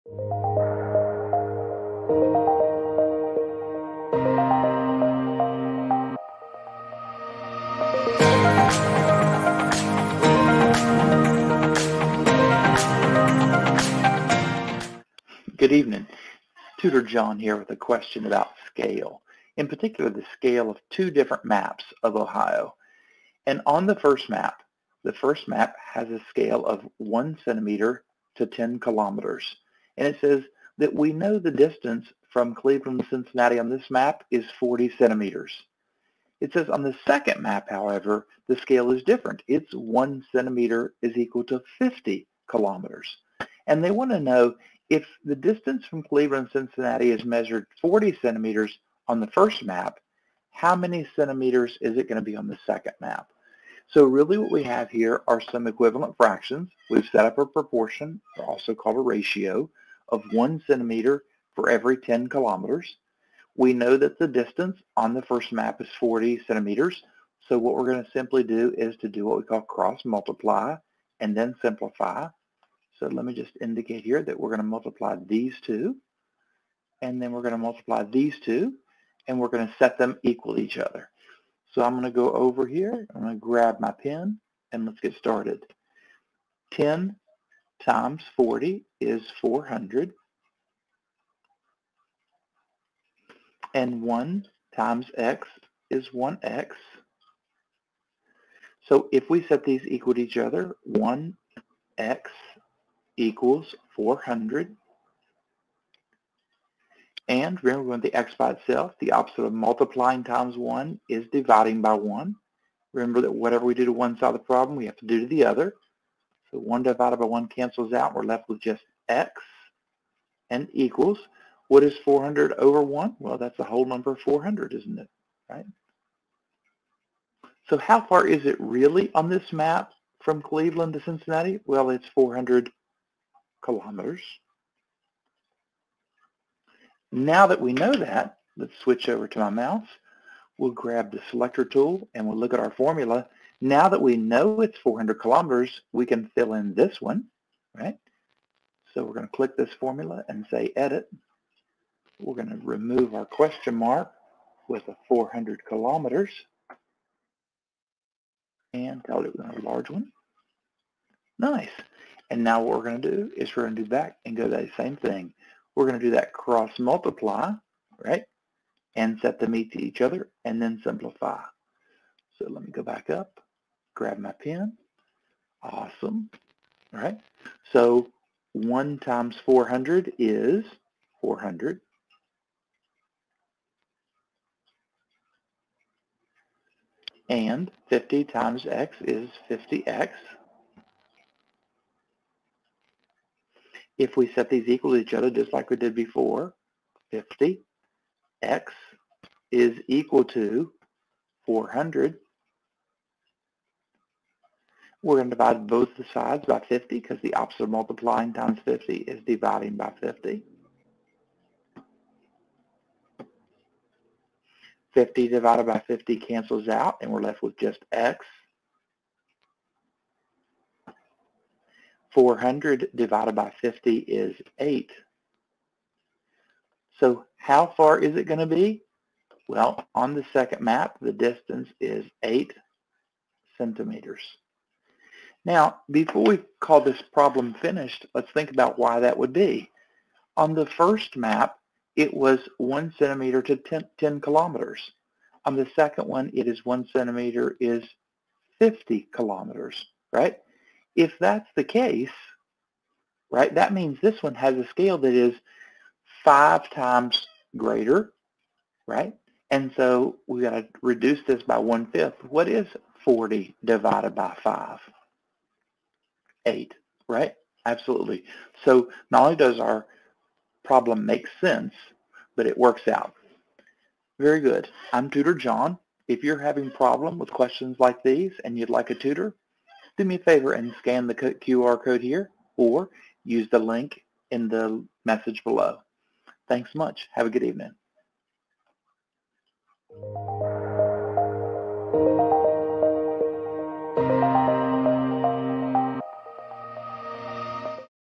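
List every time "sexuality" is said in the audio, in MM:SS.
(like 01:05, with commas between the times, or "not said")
not said.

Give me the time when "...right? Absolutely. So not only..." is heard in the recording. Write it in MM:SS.
04:27.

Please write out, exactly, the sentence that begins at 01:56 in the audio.
So 1 divided by 1 cancels out.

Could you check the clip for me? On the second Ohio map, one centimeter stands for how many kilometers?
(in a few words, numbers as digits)
50 kilometers.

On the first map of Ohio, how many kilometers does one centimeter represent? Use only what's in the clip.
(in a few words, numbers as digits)
10 kilometers.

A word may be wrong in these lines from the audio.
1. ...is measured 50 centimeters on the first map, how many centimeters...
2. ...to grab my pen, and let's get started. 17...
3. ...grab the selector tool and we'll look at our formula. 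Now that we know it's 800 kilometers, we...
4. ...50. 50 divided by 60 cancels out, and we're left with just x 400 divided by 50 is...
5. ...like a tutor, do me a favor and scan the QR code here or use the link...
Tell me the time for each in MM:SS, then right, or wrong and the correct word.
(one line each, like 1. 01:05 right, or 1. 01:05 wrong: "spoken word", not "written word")
1. 00:47 wrong: "40", not "50"
2. 01:23 wrong: "10", not "17"
3. 02:20 wrong: "400", not "800"
4. 03:30 wrong: "50", not "60"
5. 04:38 right.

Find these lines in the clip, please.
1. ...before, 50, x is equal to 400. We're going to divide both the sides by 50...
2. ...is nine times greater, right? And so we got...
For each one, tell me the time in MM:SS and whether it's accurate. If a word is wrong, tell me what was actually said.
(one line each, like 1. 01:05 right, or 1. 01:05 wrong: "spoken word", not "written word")
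1. 03:15 right
2. 04:15 wrong: "five", not "nine".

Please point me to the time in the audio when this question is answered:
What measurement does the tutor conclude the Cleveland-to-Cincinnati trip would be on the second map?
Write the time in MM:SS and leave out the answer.
03:52.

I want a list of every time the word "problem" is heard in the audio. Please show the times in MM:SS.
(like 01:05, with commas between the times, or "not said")
01:54, 03:57, 04:30, 04:36.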